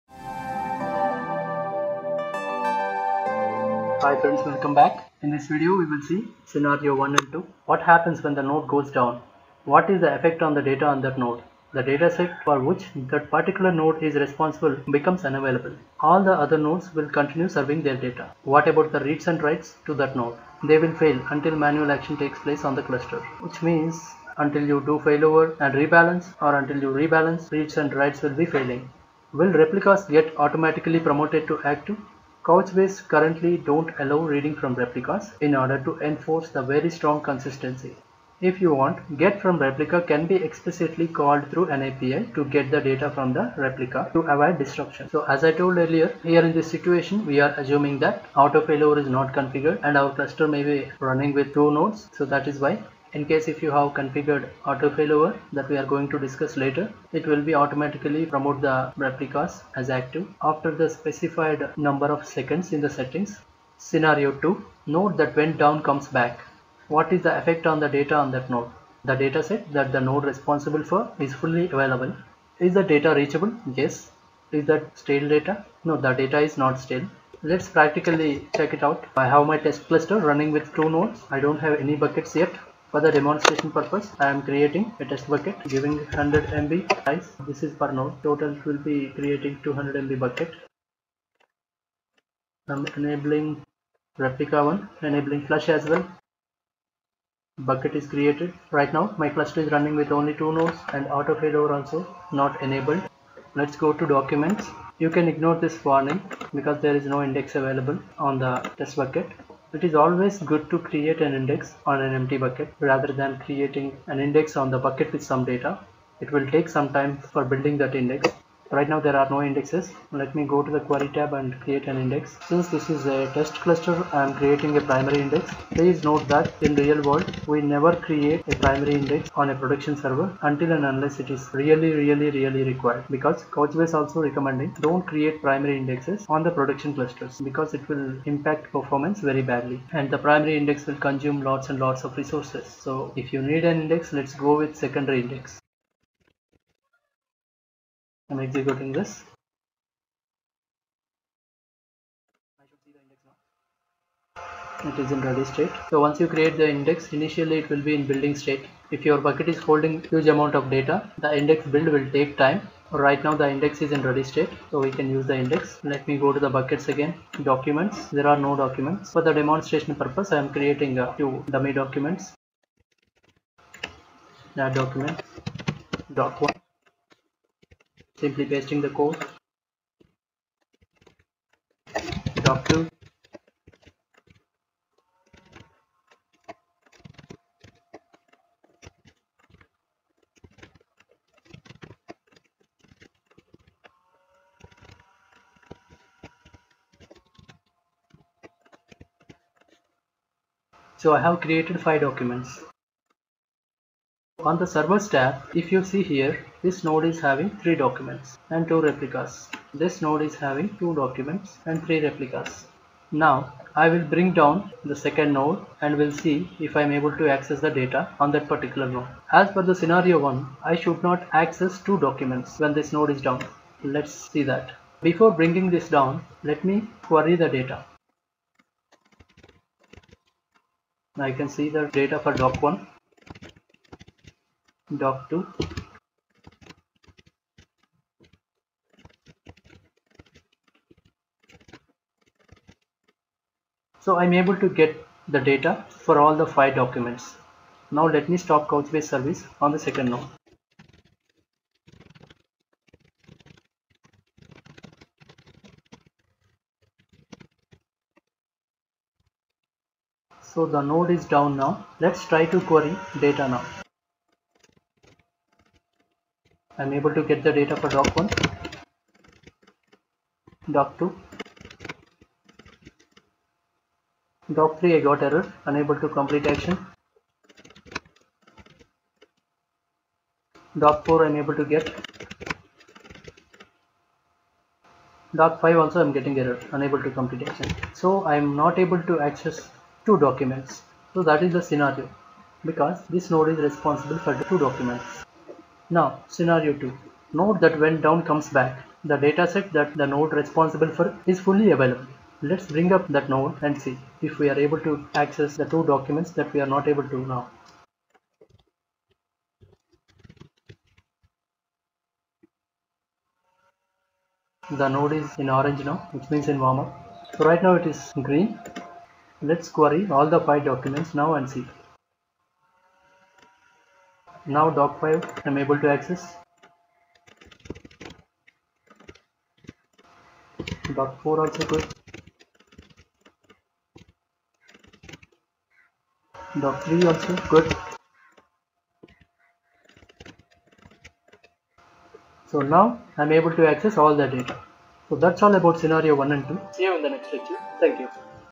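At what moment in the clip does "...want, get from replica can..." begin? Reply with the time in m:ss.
0:38.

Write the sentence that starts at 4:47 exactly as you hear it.
So I'm not able to access two documents.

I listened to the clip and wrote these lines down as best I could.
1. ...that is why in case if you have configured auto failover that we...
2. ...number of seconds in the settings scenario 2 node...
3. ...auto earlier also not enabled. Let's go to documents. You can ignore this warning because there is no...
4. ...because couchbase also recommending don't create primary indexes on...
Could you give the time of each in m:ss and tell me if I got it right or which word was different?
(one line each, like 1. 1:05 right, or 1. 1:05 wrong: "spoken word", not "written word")
1. 0:52 right
2. 1:01 right
3. 1:41 wrong: "failover", not "earlier"
4. 2:13 right.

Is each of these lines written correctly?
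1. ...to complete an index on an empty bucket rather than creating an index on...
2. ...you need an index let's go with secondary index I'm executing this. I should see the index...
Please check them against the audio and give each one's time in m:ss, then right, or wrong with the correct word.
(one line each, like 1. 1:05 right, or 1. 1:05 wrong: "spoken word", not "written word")
1. 1:50 wrong: "create", not "complete"
2. 2:23 right.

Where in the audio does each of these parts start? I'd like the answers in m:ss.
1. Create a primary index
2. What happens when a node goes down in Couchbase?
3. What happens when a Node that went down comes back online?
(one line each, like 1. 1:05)
1. 1:49
2. 3:34
3. 4:55.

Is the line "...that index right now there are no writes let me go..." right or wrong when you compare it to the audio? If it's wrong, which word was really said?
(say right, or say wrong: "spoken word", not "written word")
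wrong: "indexes", not "writes".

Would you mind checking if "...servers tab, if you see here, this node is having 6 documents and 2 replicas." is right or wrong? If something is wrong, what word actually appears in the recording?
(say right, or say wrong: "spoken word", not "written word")
wrong: "3", not "6".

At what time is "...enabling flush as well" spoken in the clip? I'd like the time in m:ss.
1:35.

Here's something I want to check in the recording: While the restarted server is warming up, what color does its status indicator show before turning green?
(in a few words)
Orange.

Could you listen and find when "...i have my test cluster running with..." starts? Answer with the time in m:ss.
1:19.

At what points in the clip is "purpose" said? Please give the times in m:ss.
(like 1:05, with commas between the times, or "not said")
1:23, 2:49.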